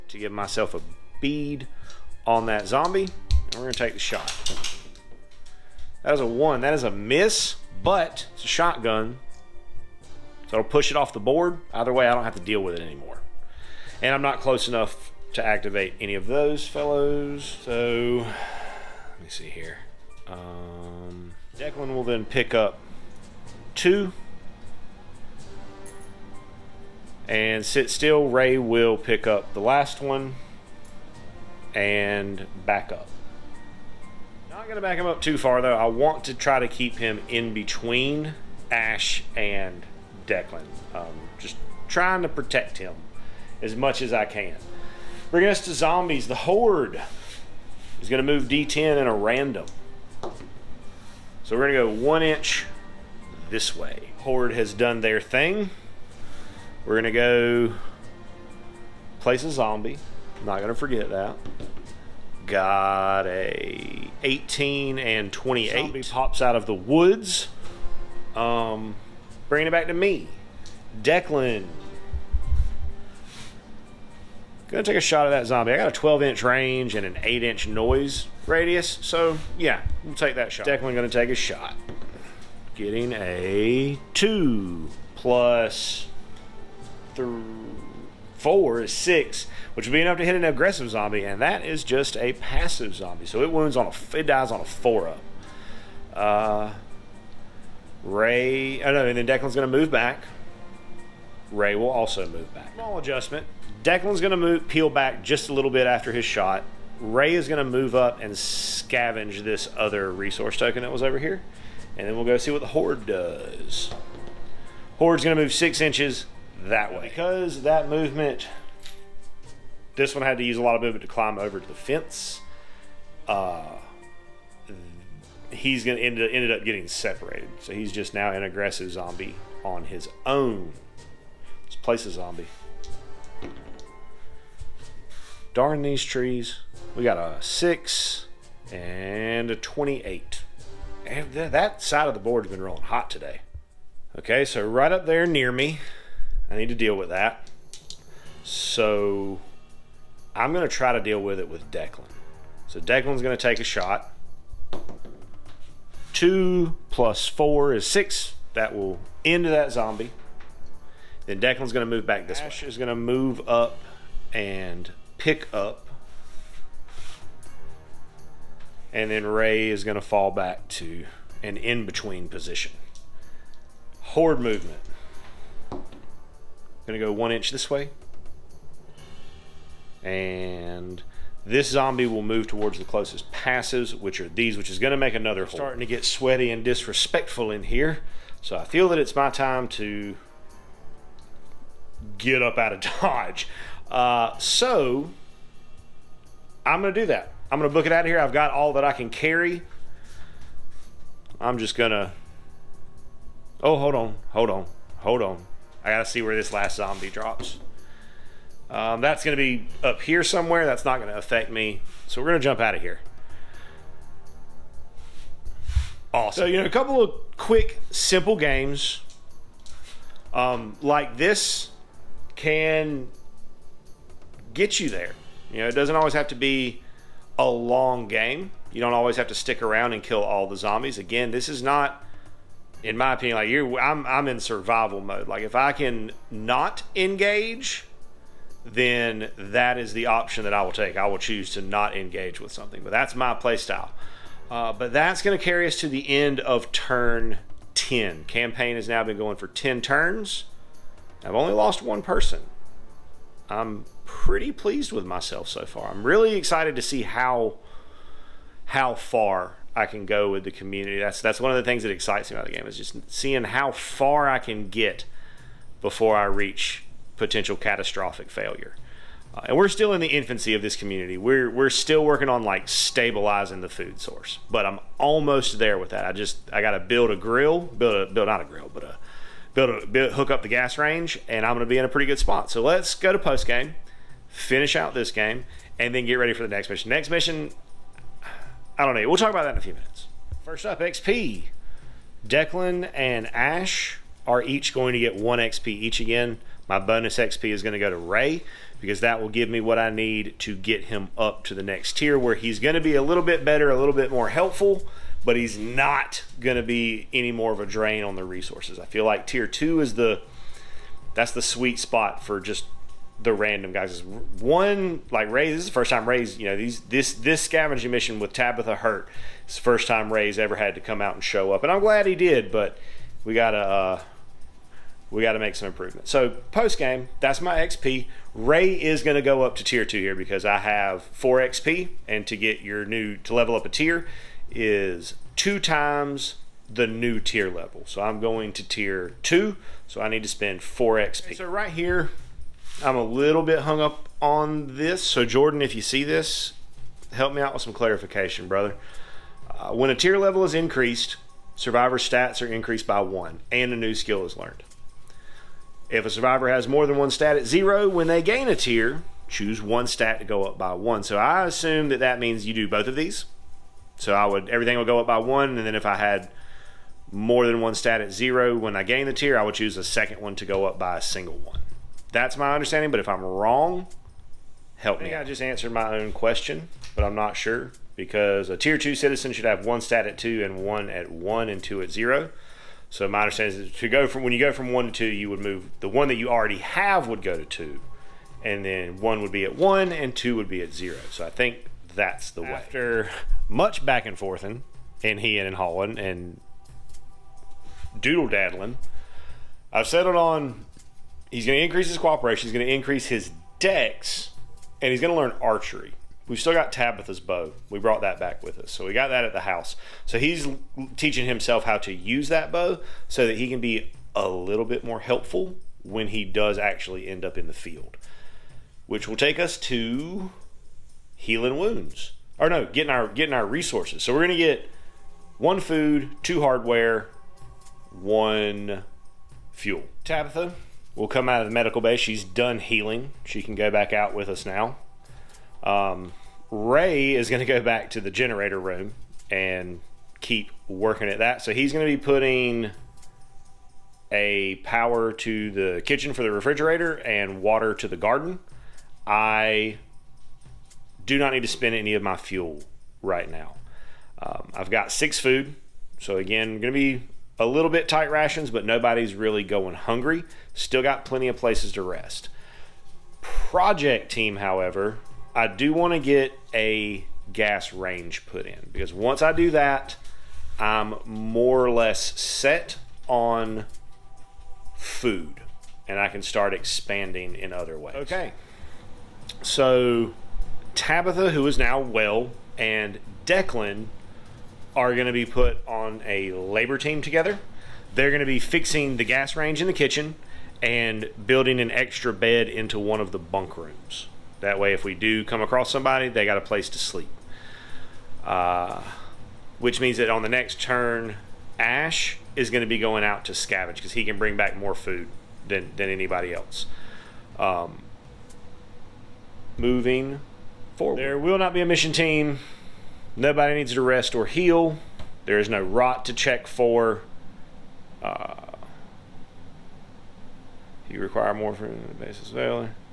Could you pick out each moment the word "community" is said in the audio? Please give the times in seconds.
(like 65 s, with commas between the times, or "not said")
260 s, 270 s.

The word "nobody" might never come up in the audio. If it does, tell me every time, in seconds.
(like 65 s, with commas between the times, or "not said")
458 s, 513 s.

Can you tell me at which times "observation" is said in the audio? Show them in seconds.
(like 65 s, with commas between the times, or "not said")
not said.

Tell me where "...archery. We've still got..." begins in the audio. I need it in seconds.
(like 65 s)
405 s.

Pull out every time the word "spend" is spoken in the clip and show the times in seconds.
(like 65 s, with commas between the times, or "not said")
340 s, 451 s.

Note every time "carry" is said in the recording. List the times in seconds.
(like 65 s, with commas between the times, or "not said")
199 s, 245 s.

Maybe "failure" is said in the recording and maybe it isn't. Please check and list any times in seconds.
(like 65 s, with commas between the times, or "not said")
268 s, 522 s.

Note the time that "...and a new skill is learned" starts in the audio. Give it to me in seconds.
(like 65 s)
353 s.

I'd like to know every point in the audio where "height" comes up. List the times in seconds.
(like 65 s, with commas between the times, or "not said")
not said.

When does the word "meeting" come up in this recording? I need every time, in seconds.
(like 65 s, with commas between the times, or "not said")
not said.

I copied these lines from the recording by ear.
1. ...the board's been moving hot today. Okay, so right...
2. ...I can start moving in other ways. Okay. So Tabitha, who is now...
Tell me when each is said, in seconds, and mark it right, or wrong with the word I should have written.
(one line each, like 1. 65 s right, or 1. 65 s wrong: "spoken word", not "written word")
1. 142 s wrong: "rolling", not "moving"
2. 475 s wrong: "expanding", not "moving".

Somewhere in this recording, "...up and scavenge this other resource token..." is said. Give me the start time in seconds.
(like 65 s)
107 s.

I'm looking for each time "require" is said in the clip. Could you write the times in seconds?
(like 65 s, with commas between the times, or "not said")
521 s.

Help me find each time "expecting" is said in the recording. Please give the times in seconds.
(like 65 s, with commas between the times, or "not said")
not said.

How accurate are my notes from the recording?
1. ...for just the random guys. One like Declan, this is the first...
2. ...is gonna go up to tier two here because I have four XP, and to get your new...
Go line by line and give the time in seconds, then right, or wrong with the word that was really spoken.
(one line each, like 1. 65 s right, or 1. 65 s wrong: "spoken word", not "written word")
1. 312 s wrong: "Ray", not "Declan"
2. 328 s right.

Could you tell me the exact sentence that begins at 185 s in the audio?
Starting to get sweaty and disrespectful in here.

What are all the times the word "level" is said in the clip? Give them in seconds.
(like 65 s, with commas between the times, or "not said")
333 s, 337 s, 350 s.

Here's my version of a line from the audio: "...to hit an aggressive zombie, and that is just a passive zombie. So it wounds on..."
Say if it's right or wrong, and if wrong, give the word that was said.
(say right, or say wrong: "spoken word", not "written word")
right.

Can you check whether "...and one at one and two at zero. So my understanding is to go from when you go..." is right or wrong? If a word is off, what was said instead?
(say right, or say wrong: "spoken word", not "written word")
right.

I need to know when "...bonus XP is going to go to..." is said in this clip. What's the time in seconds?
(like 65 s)
296 s.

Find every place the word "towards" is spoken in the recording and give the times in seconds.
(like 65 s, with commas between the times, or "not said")
182 s.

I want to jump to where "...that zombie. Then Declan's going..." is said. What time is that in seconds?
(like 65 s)
159 s.